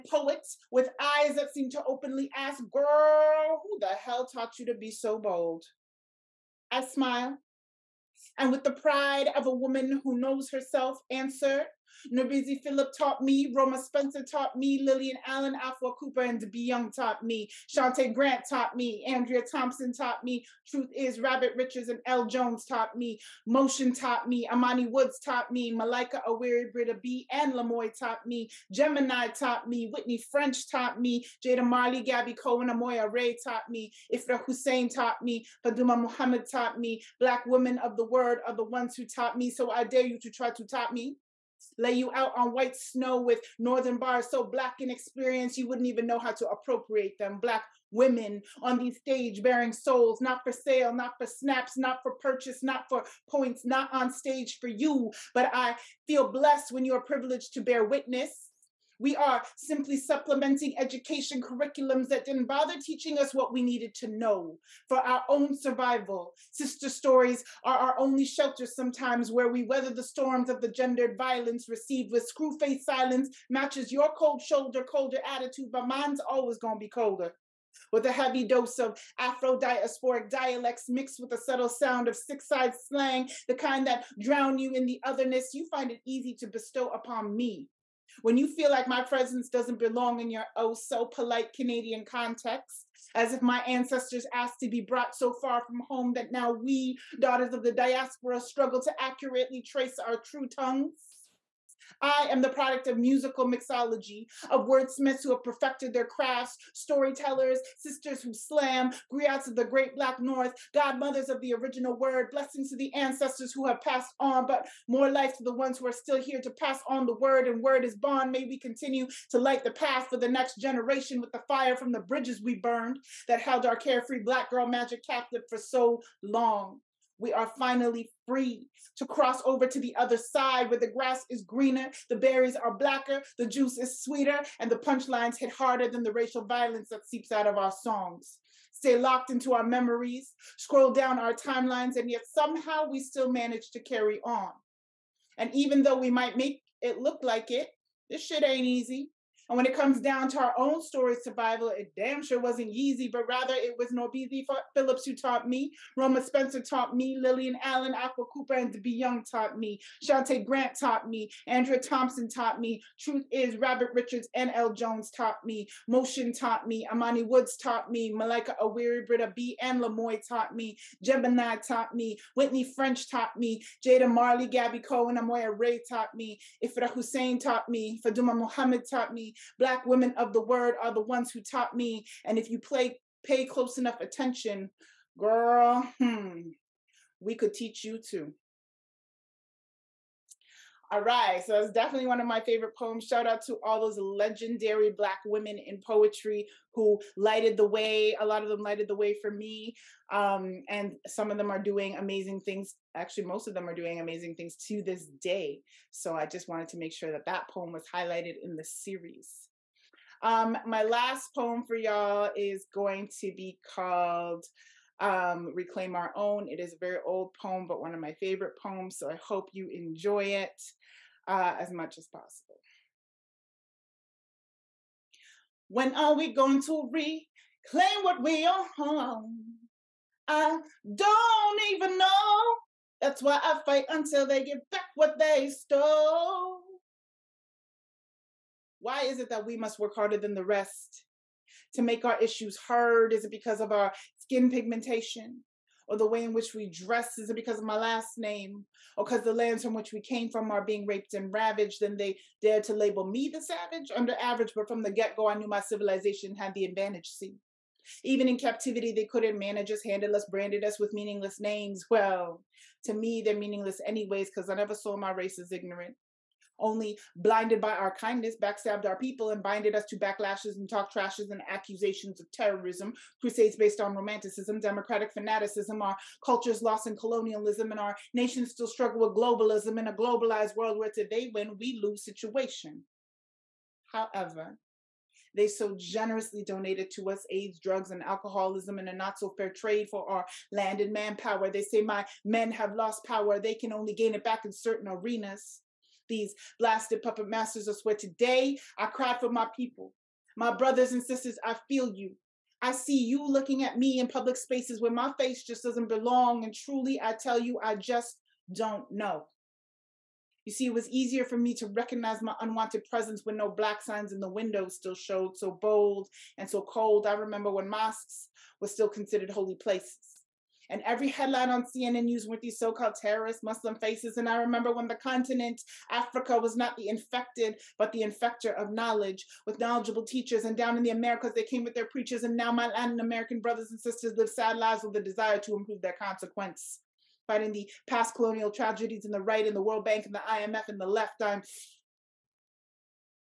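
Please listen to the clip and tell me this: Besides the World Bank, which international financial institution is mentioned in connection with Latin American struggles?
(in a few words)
IMF.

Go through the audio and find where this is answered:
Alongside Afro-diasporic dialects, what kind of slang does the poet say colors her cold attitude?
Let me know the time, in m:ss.
1:22.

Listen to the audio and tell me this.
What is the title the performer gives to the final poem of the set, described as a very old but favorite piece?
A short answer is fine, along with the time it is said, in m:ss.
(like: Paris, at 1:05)
Reclaim Our Own, at 3:35.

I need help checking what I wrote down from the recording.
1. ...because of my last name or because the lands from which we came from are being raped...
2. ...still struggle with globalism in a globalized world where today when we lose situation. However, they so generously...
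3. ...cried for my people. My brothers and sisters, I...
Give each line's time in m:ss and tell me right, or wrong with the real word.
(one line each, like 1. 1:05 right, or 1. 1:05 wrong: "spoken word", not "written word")
1. 4:07 right
2. 4:38 right
3. 4:58 right.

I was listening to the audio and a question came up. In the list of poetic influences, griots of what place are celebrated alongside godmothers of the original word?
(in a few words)
the great black north.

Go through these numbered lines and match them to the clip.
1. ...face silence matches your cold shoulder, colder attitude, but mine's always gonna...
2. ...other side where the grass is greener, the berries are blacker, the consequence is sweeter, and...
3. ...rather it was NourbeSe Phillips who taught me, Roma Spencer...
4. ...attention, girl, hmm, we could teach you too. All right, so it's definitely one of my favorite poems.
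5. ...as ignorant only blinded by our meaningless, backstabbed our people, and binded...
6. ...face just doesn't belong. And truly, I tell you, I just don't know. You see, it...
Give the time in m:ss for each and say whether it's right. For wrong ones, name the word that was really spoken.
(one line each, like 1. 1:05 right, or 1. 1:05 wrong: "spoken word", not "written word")
1. 1:12 right
2. 2:09 wrong: "juice", not "consequence"
3. 2:33 right
4. 3:03 right
5. 4:25 wrong: "kindness", not "meaningless"
6. 5:05 right.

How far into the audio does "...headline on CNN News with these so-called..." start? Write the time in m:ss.
5:21.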